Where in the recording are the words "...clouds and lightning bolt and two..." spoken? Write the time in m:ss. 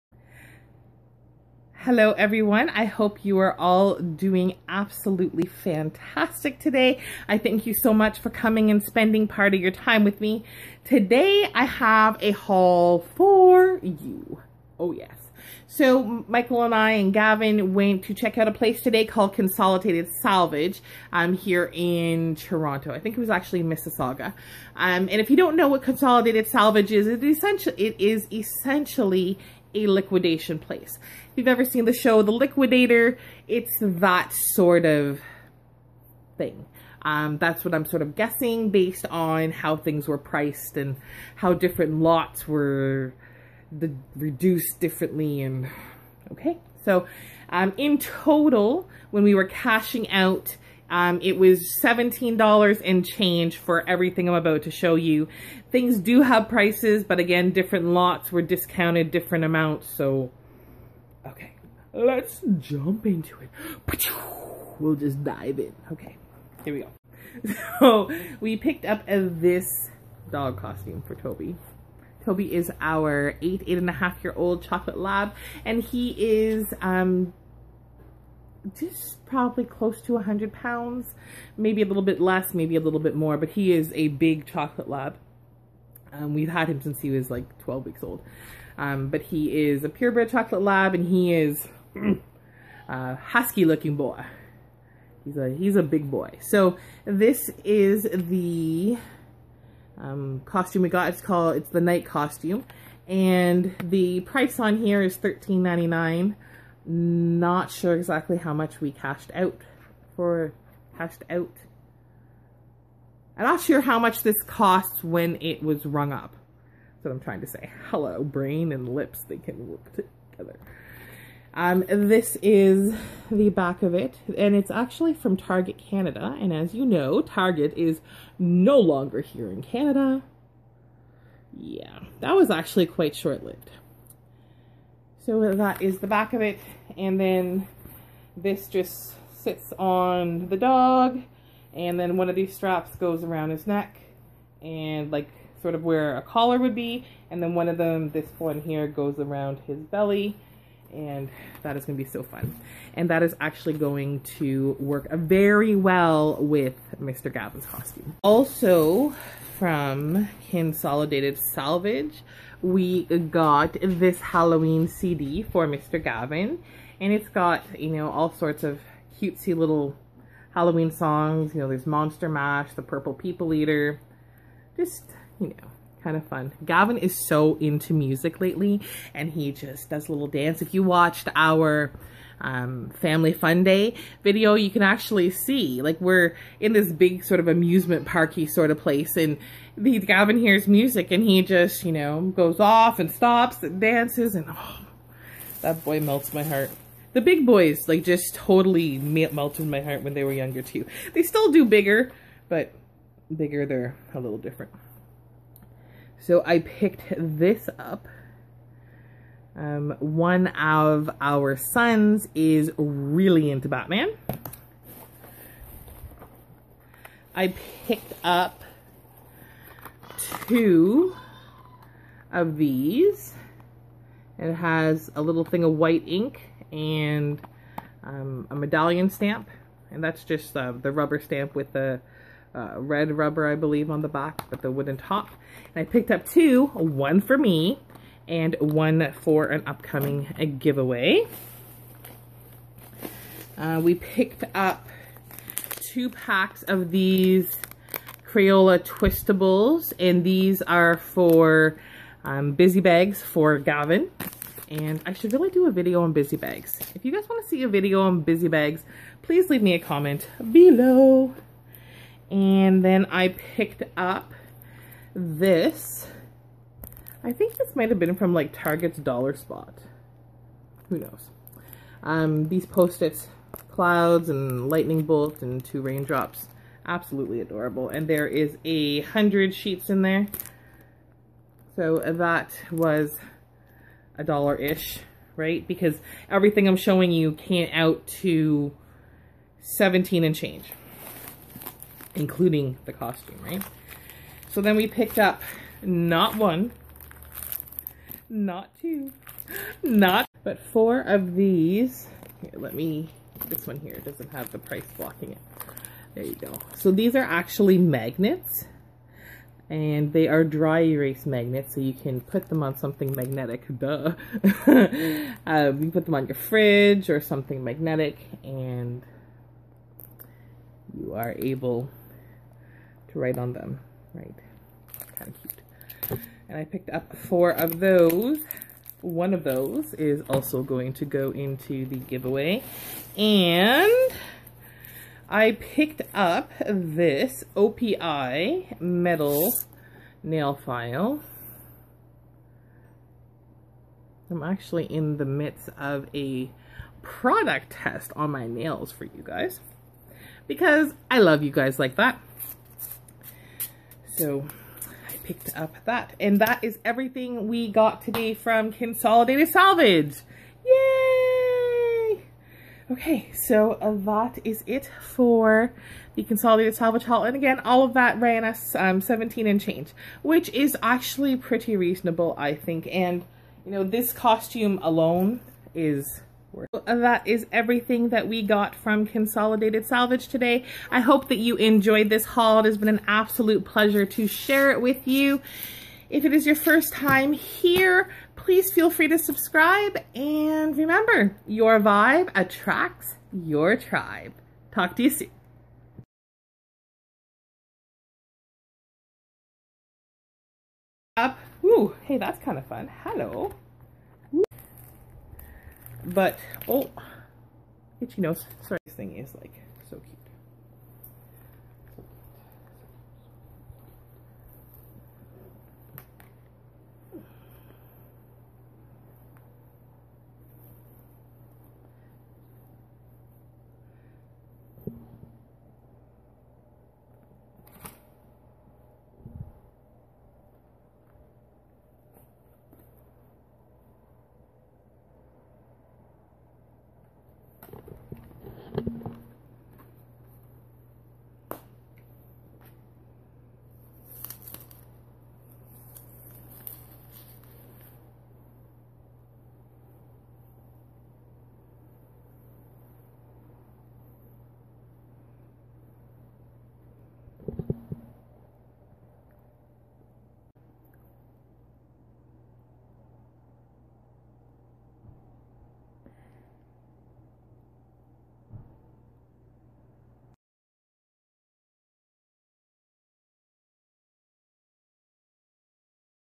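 4:33.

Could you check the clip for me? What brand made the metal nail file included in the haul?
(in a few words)
OPI.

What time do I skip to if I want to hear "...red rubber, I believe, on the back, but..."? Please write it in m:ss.
3:52.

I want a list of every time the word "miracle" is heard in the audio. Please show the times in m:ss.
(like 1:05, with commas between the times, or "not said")
not said.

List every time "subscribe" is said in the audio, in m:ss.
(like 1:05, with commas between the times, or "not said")
6:29.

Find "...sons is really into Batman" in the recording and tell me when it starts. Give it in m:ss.
3:31.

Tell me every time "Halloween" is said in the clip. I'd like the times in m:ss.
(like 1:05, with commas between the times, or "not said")
2:44, 2:50.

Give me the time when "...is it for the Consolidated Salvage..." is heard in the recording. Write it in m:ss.
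6:04.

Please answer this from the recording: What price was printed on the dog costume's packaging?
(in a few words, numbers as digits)
$13.99.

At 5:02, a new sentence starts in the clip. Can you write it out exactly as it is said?
Here, let me, this one here doesn't have the price blocking it.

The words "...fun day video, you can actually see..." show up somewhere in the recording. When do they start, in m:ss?
3:03.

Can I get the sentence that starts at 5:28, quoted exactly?
One of those is also going to go into the giveaway.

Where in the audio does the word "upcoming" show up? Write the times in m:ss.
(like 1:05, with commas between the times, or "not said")
3:59.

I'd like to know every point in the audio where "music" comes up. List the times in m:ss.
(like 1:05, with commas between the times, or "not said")
2:57, 3:10.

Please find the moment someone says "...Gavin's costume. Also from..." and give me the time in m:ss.
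2:37.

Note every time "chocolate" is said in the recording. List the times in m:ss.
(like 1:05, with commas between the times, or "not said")
1:14, 1:24, 1:30.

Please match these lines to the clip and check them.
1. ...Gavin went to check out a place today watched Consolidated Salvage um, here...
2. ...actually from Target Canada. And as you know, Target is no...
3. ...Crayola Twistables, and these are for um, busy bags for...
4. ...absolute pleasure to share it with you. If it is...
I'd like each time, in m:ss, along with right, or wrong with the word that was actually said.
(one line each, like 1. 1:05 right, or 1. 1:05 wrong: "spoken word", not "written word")
1. 0:17 wrong: "called", not "watched"
2. 2:04 right
3. 4:08 right
4. 6:23 right.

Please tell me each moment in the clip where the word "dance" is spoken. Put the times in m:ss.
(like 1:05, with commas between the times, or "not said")
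3:00, 3:13.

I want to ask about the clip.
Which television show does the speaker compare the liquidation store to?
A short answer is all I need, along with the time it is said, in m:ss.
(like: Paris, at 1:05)
The Liquidator, at 0:32.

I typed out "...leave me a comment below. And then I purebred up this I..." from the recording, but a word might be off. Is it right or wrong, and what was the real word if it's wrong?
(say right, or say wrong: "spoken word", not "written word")
wrong: "picked", not "purebred".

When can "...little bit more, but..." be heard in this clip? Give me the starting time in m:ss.
1:22.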